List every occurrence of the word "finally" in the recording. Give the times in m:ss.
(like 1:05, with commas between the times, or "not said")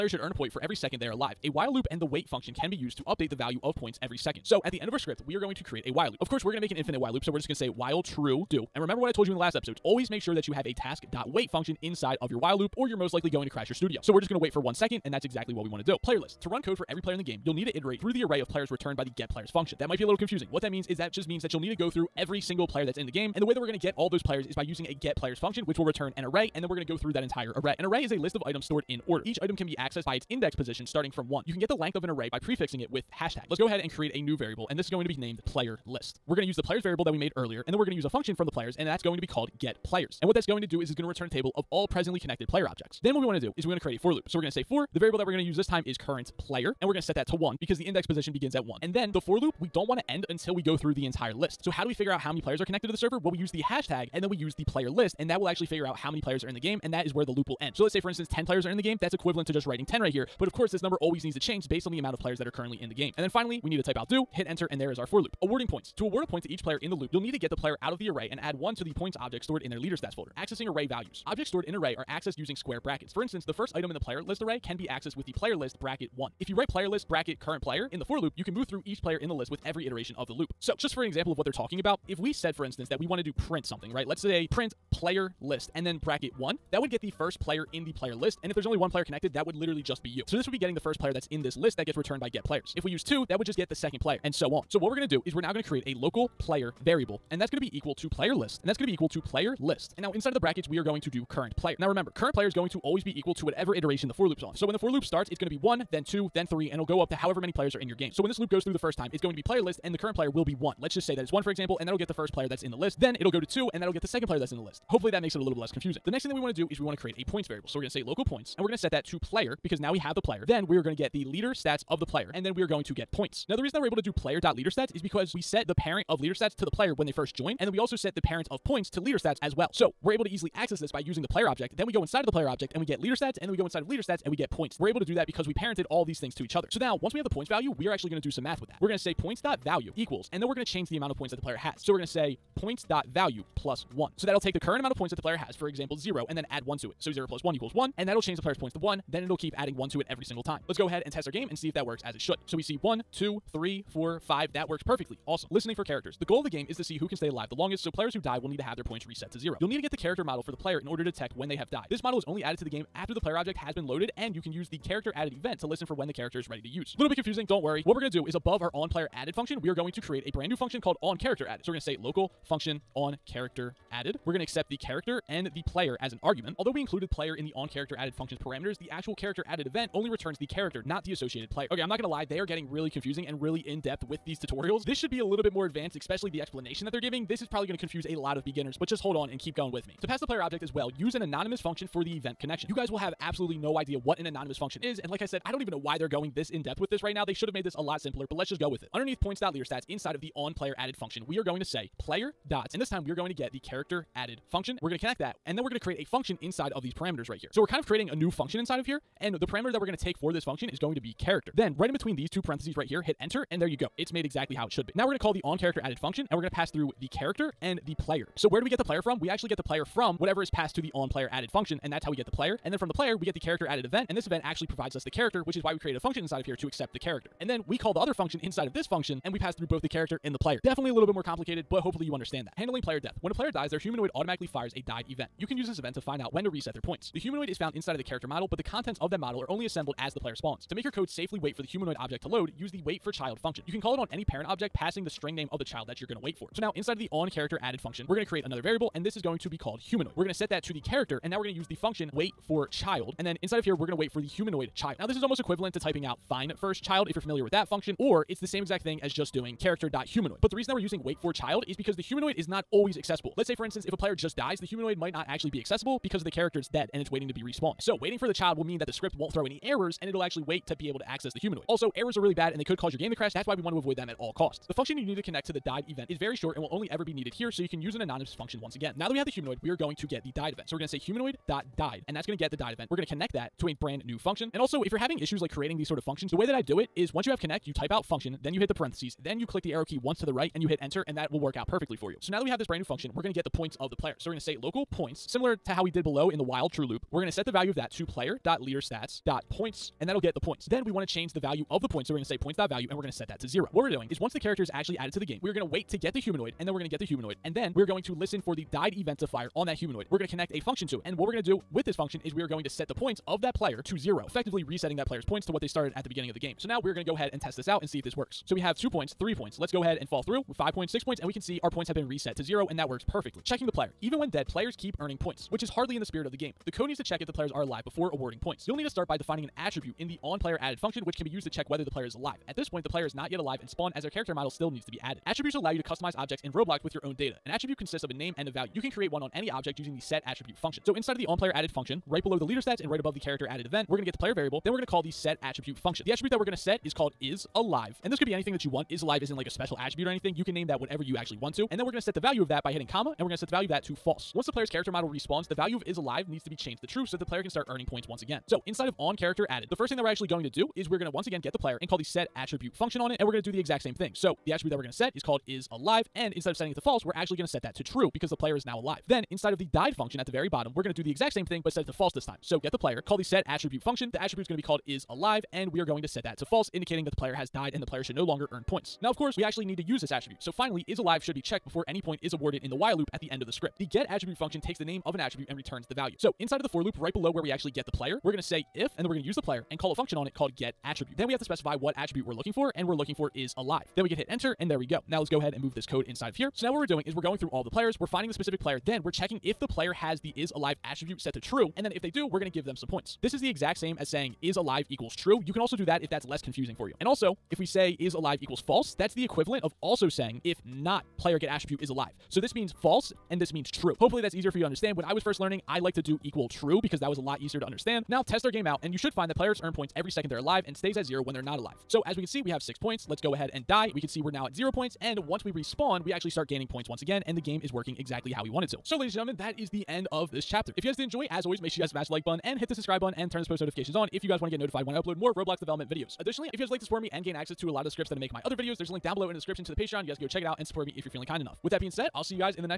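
1:03, 6:20.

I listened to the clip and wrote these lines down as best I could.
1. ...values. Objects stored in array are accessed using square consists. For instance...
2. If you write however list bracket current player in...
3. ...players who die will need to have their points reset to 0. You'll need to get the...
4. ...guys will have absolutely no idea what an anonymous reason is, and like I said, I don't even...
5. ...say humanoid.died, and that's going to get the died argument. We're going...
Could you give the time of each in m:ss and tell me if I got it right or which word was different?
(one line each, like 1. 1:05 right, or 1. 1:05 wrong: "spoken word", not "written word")
1. 1:10 wrong: "brackets", not "consists"
2. 1:16 wrong: "player", not "however"
3. 2:37 right
4. 3:12 wrong: "function", not "reason"
5. 4:40 wrong: "event", not "argument".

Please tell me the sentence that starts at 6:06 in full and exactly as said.
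And instead of setting it to false, we're actually going to set that to true because the player is now alive.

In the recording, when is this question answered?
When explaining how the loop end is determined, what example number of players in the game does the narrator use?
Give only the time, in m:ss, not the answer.
0:58.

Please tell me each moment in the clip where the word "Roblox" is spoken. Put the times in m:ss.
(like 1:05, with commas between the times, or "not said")
5:36, 7:15.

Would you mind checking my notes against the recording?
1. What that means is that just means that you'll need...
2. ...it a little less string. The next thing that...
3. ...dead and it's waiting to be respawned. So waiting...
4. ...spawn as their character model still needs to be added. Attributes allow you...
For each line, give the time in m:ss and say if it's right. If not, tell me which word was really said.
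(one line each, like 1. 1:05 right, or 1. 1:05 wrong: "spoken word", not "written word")
1. 0:20 right
2. 1:55 wrong: "confusing", not "string"
3. 4:26 right
4. 5:33 right.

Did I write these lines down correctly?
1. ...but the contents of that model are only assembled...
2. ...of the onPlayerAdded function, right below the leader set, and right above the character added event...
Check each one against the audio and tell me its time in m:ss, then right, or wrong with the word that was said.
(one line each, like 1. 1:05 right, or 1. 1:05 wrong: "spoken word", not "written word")
1. 3:58 right
2. 5:41 right.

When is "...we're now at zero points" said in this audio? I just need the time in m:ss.
7:04.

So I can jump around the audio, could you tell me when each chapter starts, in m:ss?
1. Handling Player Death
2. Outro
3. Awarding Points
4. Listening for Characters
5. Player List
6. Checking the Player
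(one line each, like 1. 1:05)
1. 3:52
2. 7:08
3. 1:04
4. 2:34
5. 0:15
6. 5:23.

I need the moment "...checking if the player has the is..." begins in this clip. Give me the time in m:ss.
6:39.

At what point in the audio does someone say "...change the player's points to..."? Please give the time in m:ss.
2:28.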